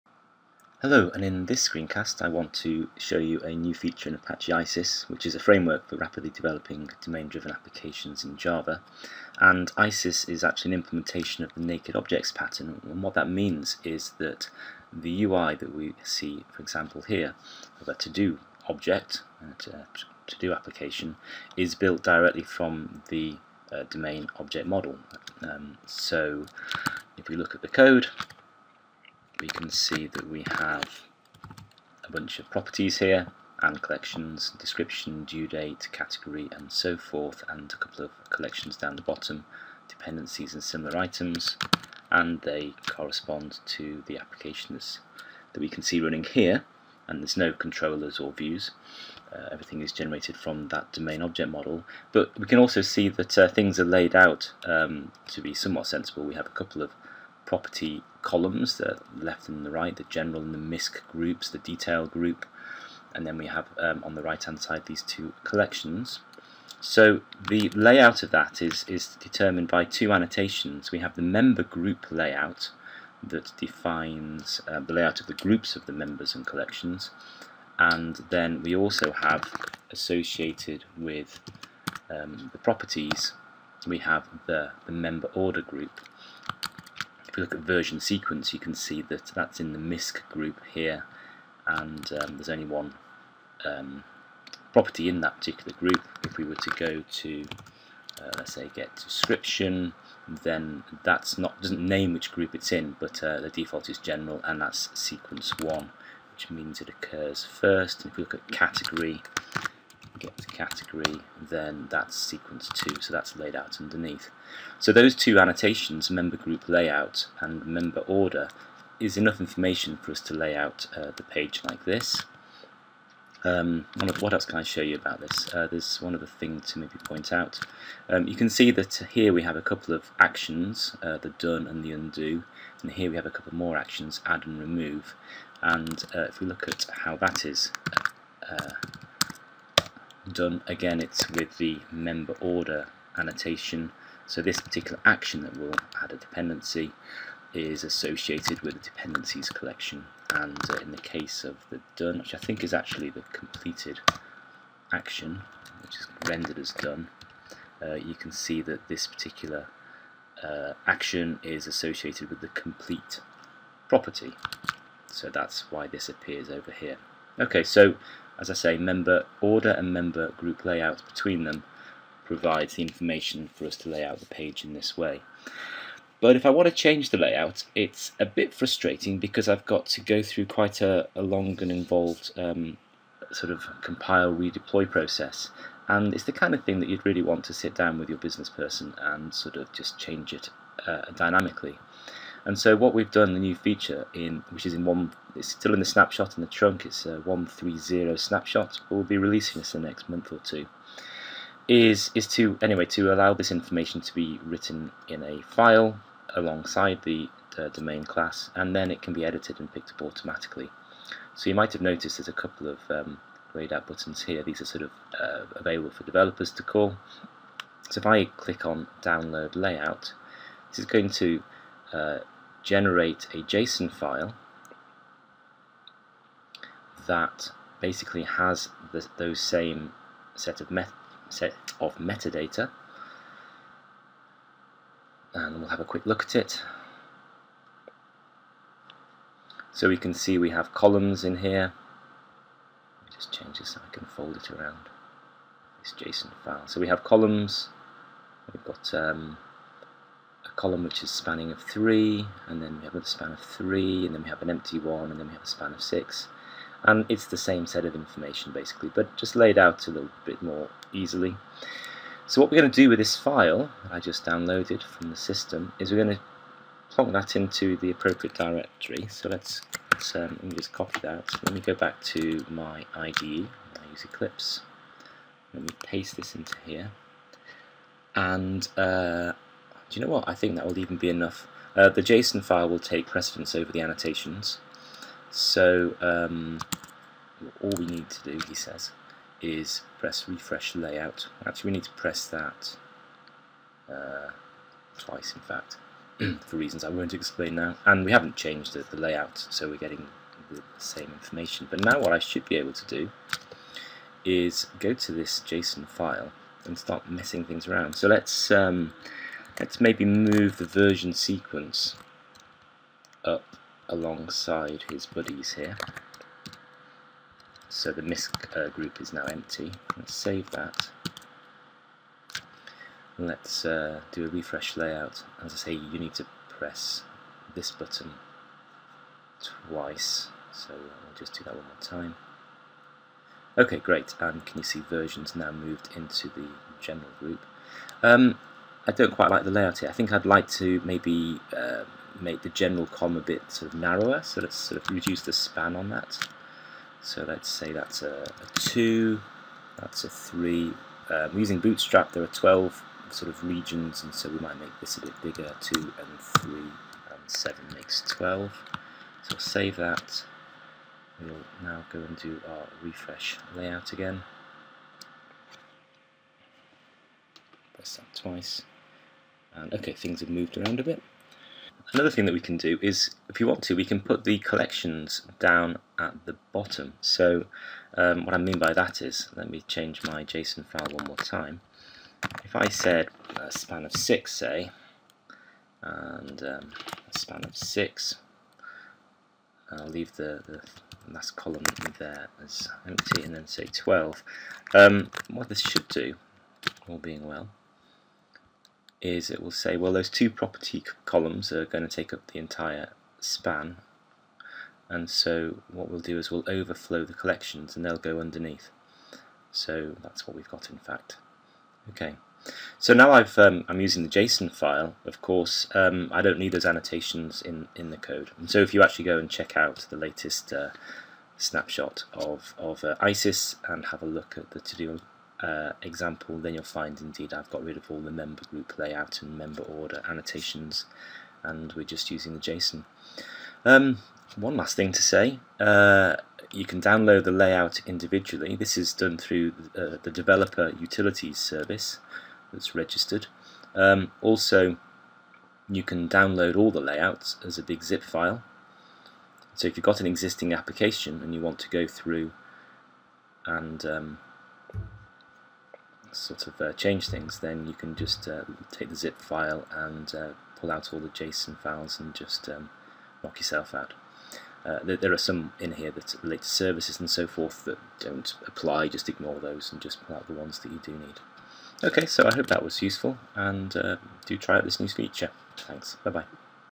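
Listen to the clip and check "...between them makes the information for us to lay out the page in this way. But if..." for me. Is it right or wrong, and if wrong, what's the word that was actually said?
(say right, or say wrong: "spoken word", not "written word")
wrong: "provides", not "makes".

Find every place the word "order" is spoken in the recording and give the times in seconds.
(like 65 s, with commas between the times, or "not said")
85 s, 118 s, 142 s, 169 s, 429 s.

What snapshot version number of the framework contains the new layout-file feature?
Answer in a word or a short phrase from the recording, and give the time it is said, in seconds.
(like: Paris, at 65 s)
1.3.0, at 197 s.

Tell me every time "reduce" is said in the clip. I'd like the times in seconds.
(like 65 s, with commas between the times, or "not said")
344 s.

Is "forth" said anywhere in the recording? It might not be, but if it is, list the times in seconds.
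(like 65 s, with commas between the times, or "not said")
36 s, 467 s.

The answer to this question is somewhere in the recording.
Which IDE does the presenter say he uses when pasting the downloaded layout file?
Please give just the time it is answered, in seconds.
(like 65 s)
274 s.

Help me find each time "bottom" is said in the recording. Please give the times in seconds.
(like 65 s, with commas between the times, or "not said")
39 s, 376 s.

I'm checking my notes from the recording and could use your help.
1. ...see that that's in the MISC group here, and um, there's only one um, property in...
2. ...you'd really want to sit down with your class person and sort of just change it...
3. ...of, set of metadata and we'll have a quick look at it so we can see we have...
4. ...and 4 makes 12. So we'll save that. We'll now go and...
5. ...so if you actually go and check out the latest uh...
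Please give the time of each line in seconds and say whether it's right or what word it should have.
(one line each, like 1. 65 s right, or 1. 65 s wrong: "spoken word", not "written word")
1. 88 s right
2. 186 s wrong: "business", not "class"
3. 230 s right
4. 356 s wrong: "7", not "4"
5. 418 s right.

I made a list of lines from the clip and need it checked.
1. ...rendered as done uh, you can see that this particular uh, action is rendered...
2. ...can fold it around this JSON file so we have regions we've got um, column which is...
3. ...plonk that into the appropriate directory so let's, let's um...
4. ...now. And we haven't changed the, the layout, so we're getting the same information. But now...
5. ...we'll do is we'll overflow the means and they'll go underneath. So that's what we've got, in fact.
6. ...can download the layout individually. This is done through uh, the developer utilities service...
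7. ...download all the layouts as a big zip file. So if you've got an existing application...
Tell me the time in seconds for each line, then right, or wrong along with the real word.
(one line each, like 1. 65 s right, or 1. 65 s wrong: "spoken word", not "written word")
1. 156 s wrong: "associated", not "rendered"
2. 243 s wrong: "columns", not "regions"
3. 266 s right
4. 297 s right
5. 405 s wrong: "collections", not "means"
6. 436 s right
7. 446 s right.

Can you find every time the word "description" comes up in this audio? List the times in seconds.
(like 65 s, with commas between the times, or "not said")
34 s, 98 s.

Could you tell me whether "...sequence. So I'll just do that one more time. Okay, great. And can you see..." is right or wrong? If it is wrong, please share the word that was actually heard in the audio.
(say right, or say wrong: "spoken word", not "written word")
wrong: "twice", not "sequence".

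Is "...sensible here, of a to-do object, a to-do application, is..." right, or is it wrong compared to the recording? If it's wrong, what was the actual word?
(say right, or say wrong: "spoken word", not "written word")
wrong: "example", not "sensible".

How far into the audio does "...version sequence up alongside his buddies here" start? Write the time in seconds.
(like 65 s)
310 s.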